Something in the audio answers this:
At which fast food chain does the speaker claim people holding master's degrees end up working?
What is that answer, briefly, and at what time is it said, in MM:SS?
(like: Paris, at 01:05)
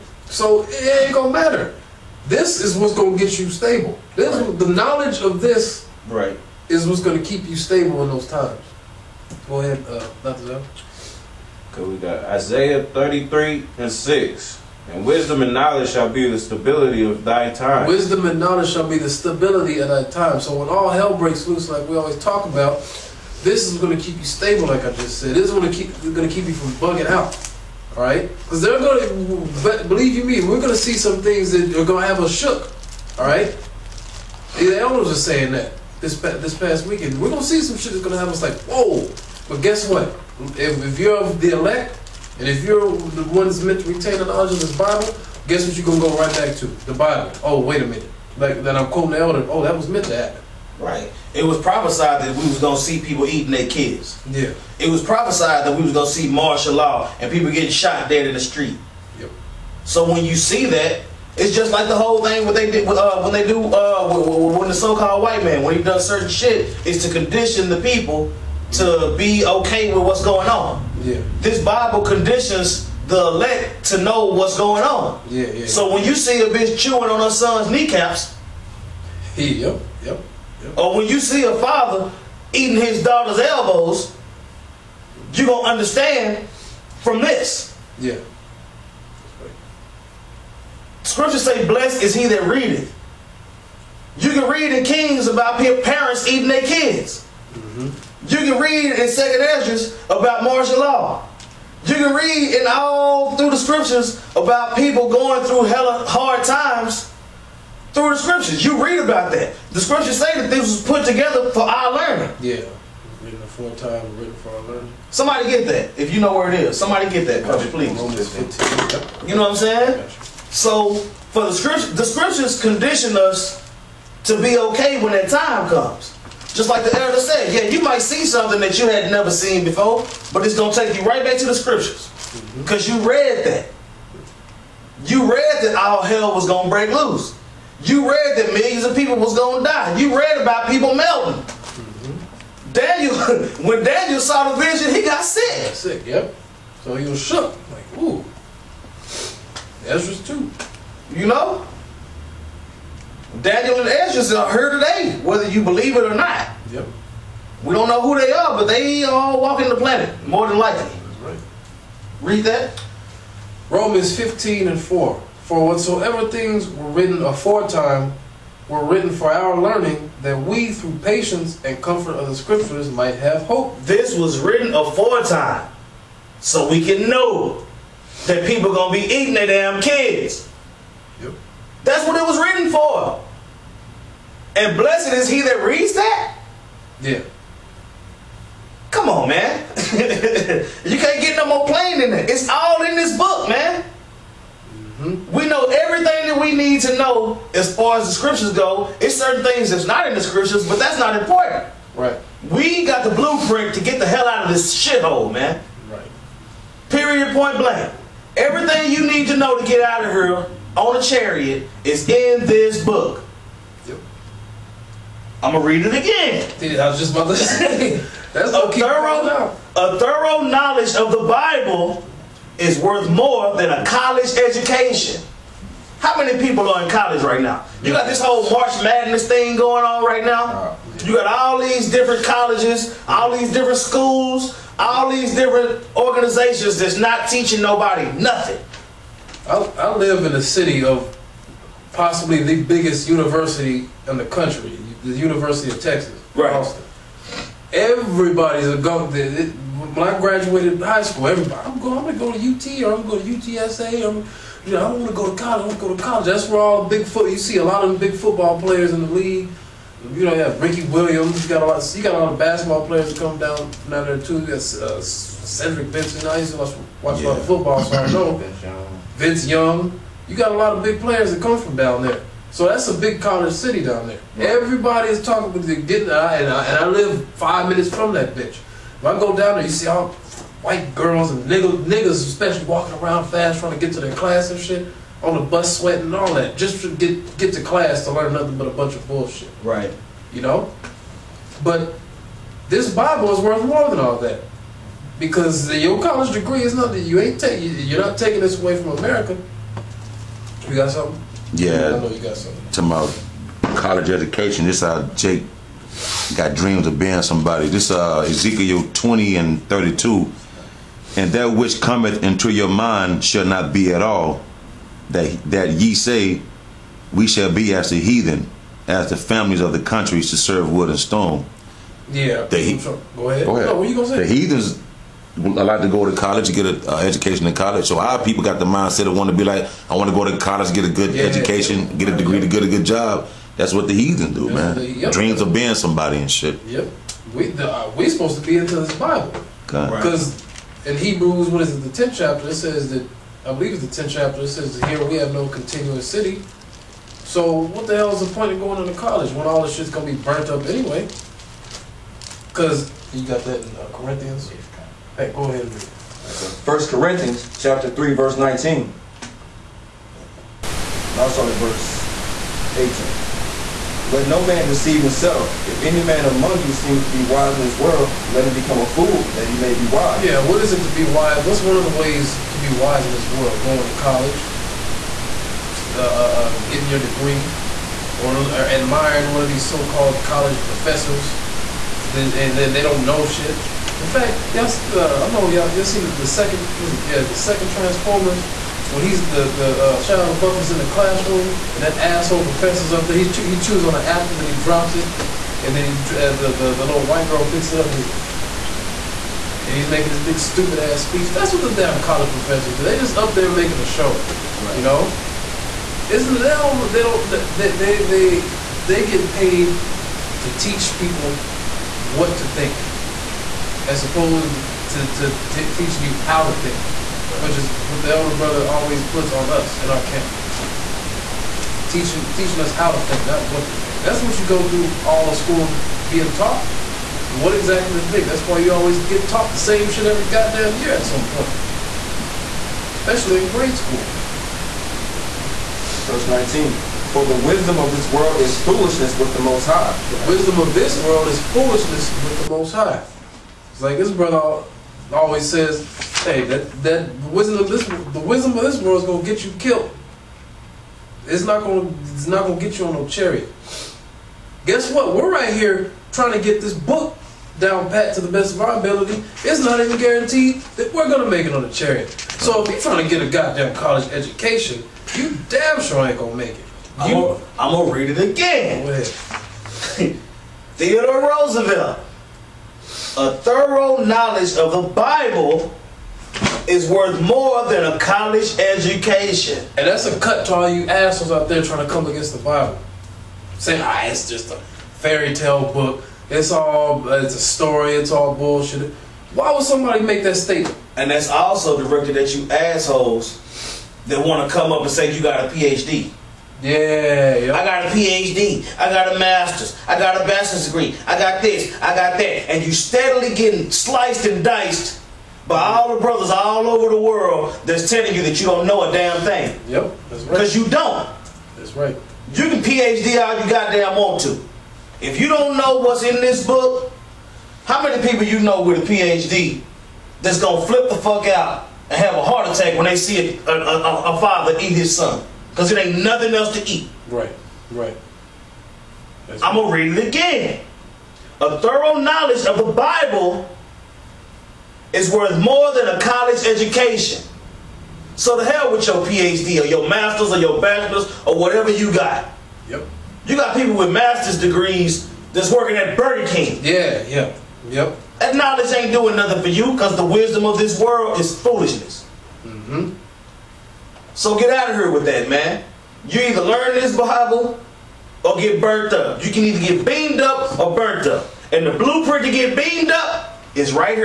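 Burger King, at 09:05.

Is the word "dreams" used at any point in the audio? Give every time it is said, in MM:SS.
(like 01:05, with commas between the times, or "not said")
05:06, 05:35.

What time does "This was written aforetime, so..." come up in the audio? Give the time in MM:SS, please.
02:53.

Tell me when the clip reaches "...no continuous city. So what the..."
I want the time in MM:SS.
05:45.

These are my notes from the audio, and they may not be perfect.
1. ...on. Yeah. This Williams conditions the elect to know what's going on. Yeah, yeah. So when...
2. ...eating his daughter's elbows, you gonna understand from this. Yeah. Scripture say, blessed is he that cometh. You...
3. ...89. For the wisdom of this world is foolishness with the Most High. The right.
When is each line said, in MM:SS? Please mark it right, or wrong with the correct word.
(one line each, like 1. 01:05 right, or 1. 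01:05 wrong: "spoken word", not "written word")
1. 01:10 wrong: "Bible", not "Williams"
2. 01:22 wrong: "readeth", not "cometh"
3. 07:16 wrong: "19", not "89".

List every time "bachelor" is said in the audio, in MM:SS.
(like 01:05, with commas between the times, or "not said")
08:20, 09:00.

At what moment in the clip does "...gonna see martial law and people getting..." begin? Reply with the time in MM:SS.
00:55.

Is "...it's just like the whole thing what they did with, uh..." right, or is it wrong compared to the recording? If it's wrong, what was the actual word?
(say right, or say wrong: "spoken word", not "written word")
right.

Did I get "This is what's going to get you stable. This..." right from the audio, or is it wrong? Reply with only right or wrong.
right.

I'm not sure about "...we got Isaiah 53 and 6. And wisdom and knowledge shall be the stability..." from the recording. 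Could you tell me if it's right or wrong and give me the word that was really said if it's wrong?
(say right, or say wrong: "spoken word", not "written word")
wrong: "33", not "53".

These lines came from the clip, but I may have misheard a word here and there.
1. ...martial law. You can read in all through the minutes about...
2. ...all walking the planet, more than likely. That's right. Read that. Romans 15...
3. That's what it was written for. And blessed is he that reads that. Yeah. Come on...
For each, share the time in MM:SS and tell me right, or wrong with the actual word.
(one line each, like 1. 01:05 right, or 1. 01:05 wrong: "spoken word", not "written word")
1. 01:40 wrong: "scriptures", not "minutes"
2. 02:39 right
3. 03:01 right.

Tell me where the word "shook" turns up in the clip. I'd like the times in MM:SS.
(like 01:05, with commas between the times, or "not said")
00:32, 02:27.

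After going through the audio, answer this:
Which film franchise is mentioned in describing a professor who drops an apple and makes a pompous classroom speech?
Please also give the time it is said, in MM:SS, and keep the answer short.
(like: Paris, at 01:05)
Transformers, at 06:27.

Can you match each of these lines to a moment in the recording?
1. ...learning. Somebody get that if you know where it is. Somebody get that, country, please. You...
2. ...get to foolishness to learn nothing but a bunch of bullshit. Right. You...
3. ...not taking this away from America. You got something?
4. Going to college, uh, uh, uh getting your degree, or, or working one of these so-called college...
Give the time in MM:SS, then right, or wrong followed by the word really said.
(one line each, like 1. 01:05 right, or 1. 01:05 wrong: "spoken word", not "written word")
1. 01:54 right
2. 04:47 wrong: "class", not "foolishness"
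3. 04:58 right
4. 06:13 wrong: "admiring", not "working".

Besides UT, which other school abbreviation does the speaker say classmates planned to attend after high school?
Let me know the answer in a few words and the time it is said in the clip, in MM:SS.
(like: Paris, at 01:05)
UTSA, at 04:13.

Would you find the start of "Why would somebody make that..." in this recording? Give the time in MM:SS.
08:09.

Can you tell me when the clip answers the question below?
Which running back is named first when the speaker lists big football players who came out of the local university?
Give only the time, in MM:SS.
04:20.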